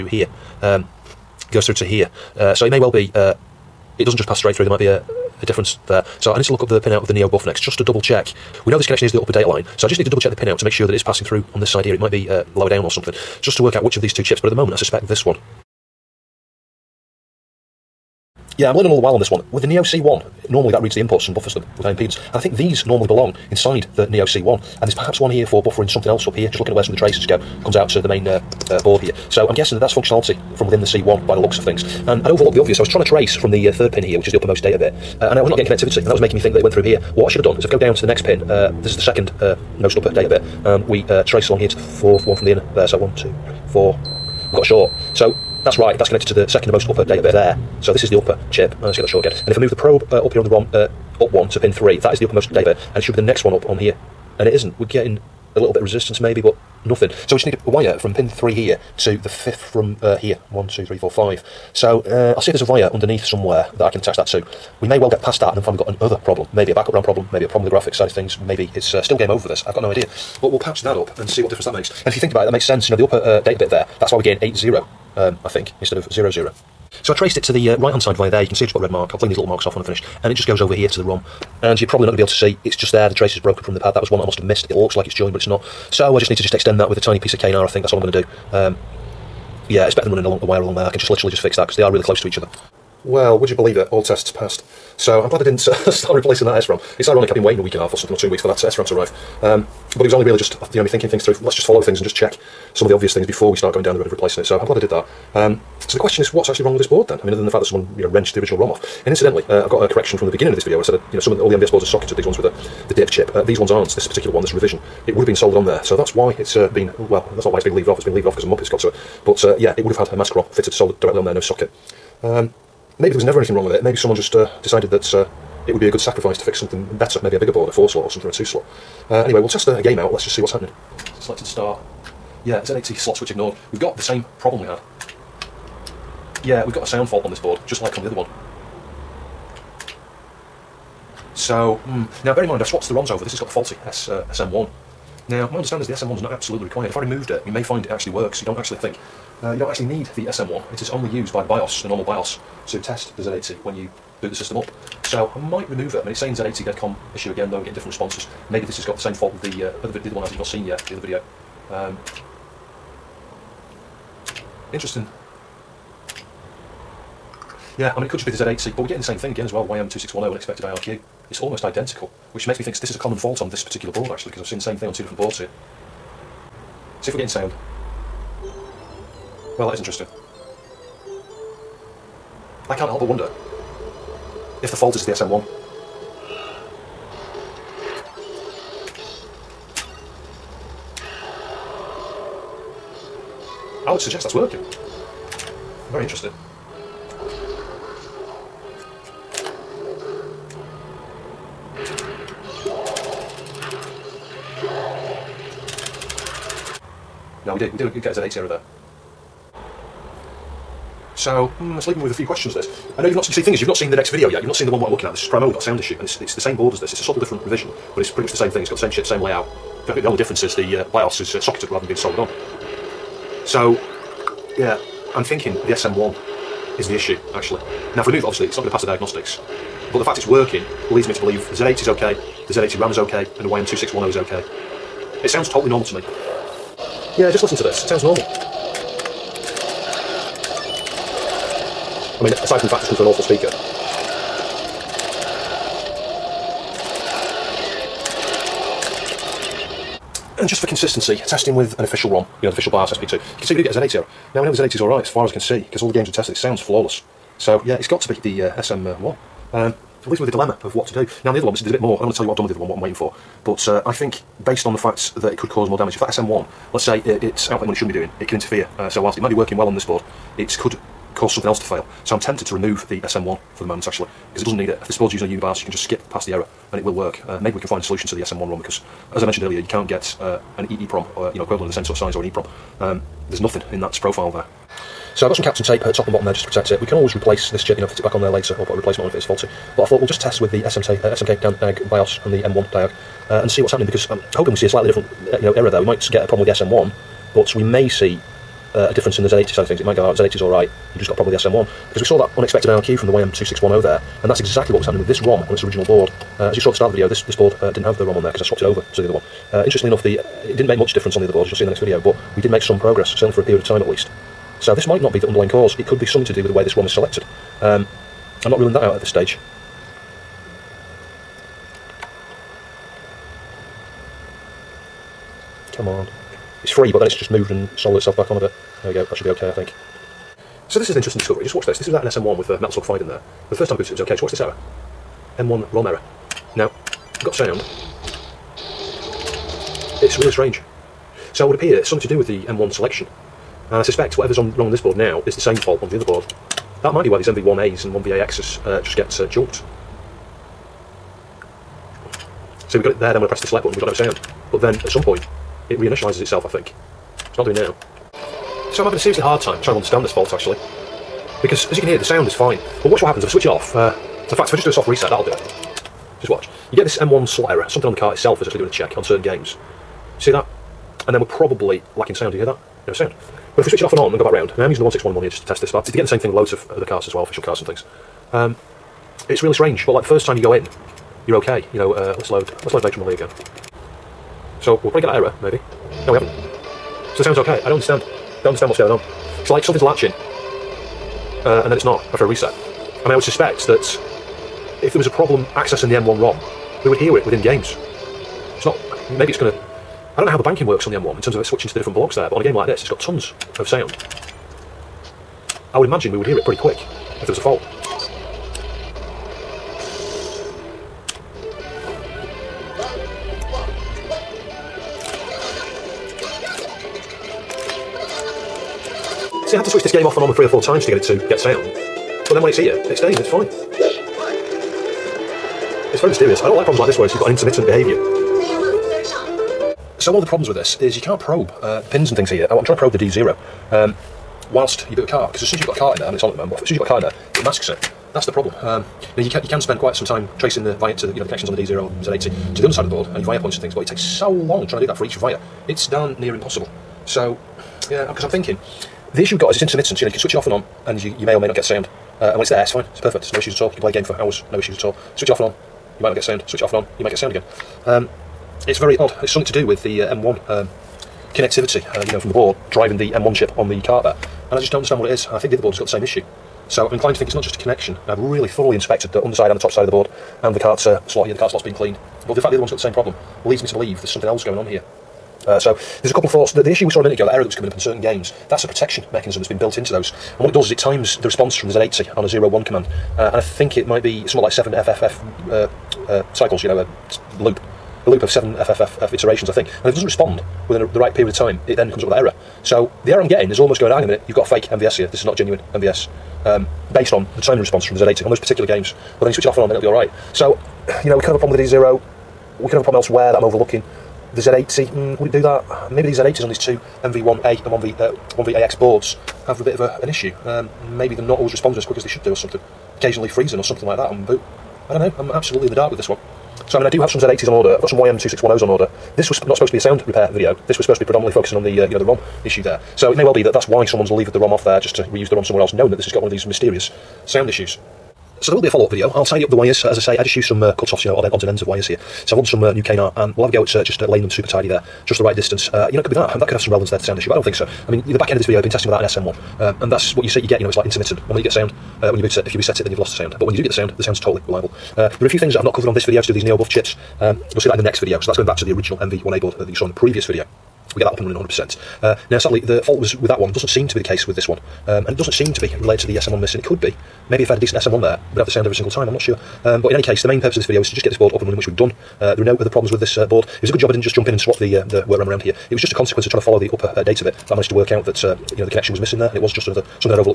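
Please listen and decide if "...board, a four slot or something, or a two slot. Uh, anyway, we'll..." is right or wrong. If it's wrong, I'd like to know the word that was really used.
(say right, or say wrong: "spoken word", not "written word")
right.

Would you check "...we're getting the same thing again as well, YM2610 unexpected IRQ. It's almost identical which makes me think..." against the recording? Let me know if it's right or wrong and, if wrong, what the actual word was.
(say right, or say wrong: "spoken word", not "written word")
right.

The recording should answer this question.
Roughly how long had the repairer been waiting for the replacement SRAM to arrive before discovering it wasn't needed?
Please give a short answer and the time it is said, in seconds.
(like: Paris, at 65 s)
A week and a half, at 97 s.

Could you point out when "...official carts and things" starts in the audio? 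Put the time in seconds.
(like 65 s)
377 s.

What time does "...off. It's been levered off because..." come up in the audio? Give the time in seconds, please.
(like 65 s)
117 s.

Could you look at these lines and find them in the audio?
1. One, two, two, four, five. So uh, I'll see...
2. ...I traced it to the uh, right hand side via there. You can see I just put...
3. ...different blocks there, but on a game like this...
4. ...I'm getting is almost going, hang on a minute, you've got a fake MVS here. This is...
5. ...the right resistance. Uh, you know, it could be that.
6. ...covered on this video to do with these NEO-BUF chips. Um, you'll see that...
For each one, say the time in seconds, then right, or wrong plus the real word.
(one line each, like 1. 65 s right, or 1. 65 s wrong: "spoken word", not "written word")
1. 60 s wrong: "three", not "two"
2. 77 s right
3. 401 s right
4. 493 s right
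5. 535 s wrong: "distance", not "resistance"
6. 545 s right.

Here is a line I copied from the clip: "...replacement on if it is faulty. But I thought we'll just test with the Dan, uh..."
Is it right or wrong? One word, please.
wrong.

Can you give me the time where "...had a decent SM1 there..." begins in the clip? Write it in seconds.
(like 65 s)
557 s.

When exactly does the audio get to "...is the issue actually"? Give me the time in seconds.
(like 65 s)
226 s.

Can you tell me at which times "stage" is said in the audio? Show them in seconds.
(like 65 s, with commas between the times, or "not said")
319 s.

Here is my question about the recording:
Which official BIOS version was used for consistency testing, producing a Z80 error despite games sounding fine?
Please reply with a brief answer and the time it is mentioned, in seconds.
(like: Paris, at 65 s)
SP2, at 252 s.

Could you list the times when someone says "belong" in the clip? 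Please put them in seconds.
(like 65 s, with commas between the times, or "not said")
23 s.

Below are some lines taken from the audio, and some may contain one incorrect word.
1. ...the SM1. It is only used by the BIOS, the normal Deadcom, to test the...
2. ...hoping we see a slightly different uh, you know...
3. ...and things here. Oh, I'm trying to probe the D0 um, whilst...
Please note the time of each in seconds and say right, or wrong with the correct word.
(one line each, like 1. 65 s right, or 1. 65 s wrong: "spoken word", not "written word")
1. 150 s wrong: "BIOS", not "Deadcom"
2. 294 s right
3. 432 s right.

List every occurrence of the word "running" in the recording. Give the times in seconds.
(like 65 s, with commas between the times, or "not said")
90 s, 551 s, 561 s.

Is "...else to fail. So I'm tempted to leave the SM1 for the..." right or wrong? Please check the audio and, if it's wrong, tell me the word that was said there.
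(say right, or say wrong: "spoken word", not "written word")
wrong: "remove", not "leave".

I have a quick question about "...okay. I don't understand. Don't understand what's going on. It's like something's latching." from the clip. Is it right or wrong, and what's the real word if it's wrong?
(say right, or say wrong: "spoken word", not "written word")
right.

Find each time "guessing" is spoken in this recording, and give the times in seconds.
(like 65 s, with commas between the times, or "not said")
29 s.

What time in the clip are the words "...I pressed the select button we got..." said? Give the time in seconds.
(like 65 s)
353 s.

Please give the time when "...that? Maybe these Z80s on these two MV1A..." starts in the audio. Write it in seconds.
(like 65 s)
505 s.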